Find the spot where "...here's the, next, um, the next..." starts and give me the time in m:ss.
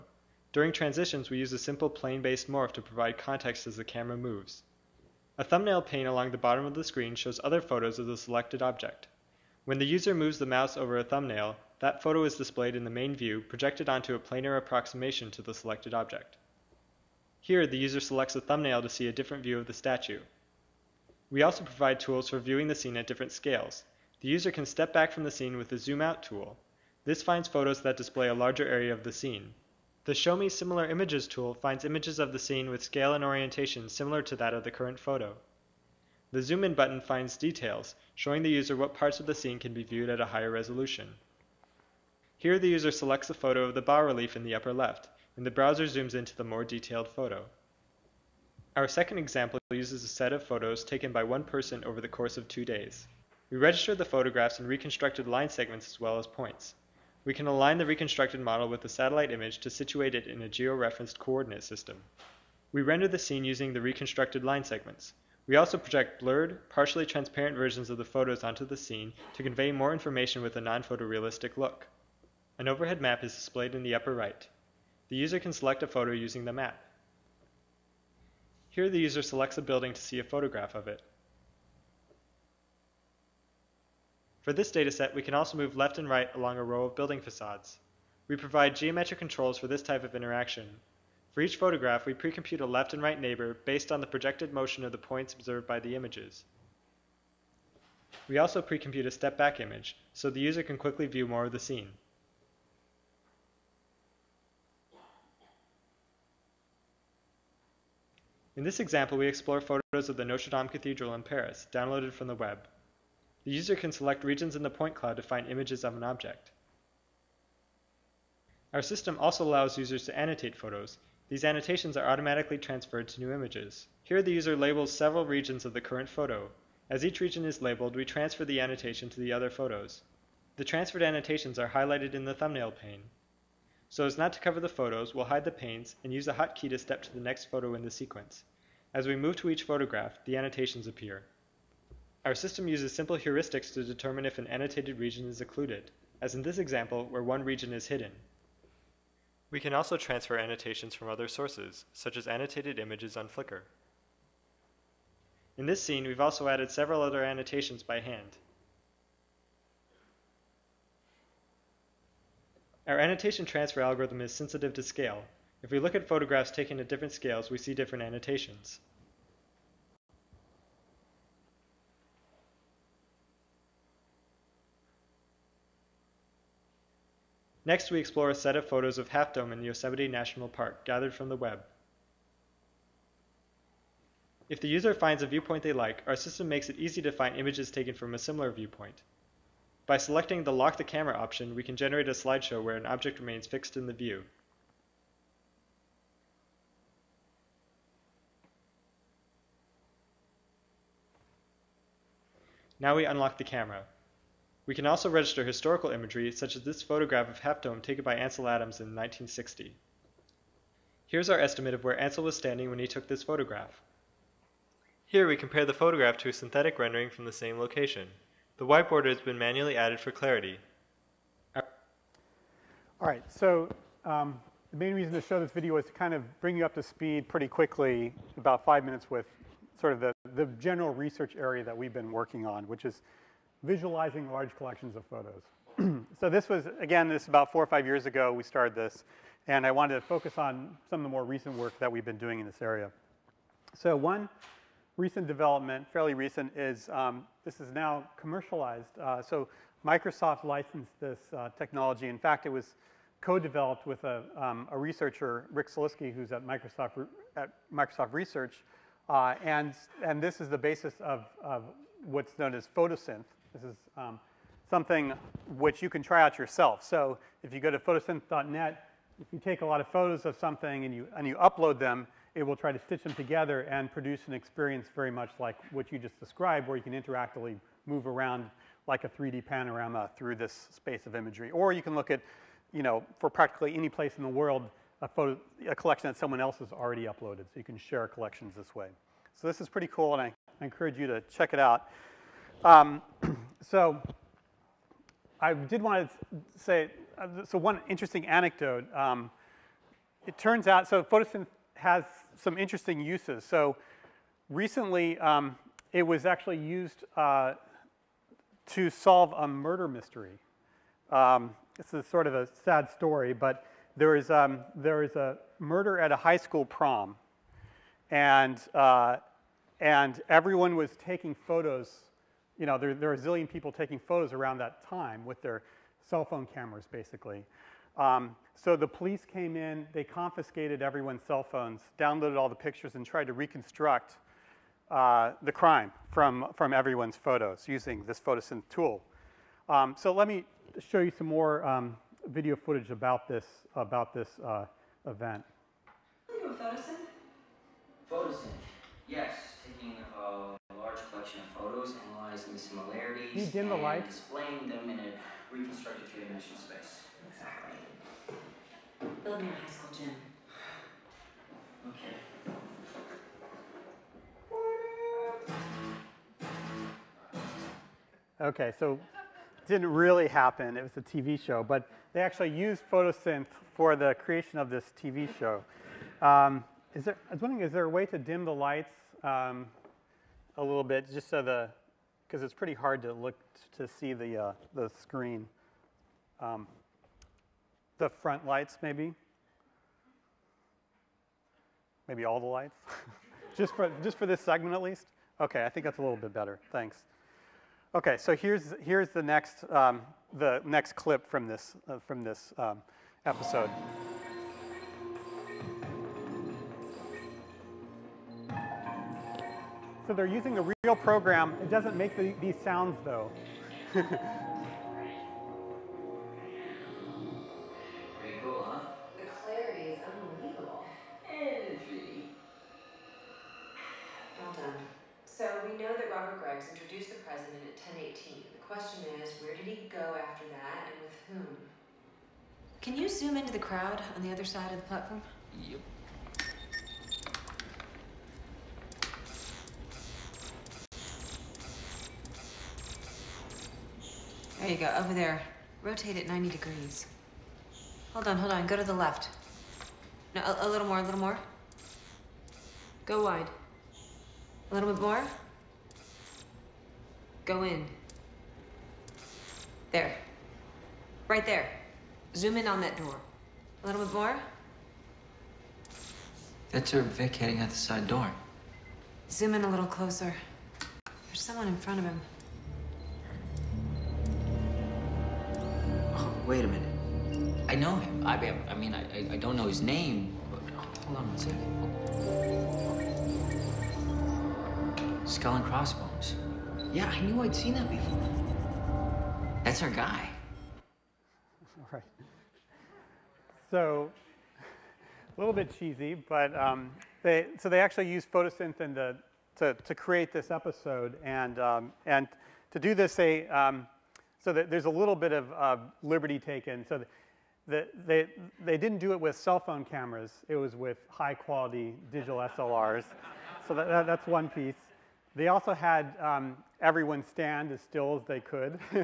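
6:38.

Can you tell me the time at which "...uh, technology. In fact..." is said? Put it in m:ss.
4:11.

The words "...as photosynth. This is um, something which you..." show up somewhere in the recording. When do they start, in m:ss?
4:22.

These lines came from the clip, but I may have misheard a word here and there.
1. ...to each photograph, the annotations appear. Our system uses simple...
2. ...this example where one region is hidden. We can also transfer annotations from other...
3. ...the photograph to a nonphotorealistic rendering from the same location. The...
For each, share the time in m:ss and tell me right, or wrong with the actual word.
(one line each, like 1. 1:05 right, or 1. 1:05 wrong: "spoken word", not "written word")
1. 2:19 right
2. 2:26 right
3. 3:35 wrong: "synthetic", not "nonphotorealistic".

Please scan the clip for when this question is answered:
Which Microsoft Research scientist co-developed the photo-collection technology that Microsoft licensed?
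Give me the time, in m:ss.
4:15.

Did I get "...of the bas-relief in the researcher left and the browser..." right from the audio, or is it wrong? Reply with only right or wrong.
wrong.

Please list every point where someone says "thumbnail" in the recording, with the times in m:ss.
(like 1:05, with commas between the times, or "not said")
0:05, 0:11, 0:18, 2:12.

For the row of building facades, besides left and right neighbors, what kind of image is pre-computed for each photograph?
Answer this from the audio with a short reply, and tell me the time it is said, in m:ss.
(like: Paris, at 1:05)
step-back image, at 1:39.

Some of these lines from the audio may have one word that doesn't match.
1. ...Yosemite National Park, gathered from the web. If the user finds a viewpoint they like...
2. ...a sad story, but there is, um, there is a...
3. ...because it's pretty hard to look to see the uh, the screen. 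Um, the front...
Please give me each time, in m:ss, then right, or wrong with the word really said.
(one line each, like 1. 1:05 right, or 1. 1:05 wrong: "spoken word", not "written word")
1. 2:59 right
2. 5:12 right
3. 6:22 right.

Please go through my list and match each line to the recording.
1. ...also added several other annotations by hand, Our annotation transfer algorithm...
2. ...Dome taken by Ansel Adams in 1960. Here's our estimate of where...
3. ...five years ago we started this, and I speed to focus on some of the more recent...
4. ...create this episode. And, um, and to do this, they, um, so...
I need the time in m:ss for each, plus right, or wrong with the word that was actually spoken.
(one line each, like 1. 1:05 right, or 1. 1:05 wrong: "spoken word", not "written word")
1. 2:36 right
2. 3:27 right
3. 3:57 wrong: "wanted", not "speed"
4. 8:19 right.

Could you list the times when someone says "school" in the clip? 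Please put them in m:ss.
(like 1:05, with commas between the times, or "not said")
5:16, 5:59.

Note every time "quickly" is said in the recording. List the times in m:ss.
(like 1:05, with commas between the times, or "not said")
1:40, 3:47.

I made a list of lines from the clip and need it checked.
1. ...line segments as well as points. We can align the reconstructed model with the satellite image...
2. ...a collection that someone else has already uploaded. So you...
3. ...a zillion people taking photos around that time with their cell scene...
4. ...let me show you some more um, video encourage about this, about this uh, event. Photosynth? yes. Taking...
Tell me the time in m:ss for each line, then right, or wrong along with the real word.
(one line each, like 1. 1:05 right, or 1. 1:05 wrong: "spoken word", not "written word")
1. 0:55 right
2. 4:45 right
3. 5:23 wrong: "phone", not "scene"
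4. 5:40 wrong: "footage", not "encourage".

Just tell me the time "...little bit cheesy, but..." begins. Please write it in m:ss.
8:15.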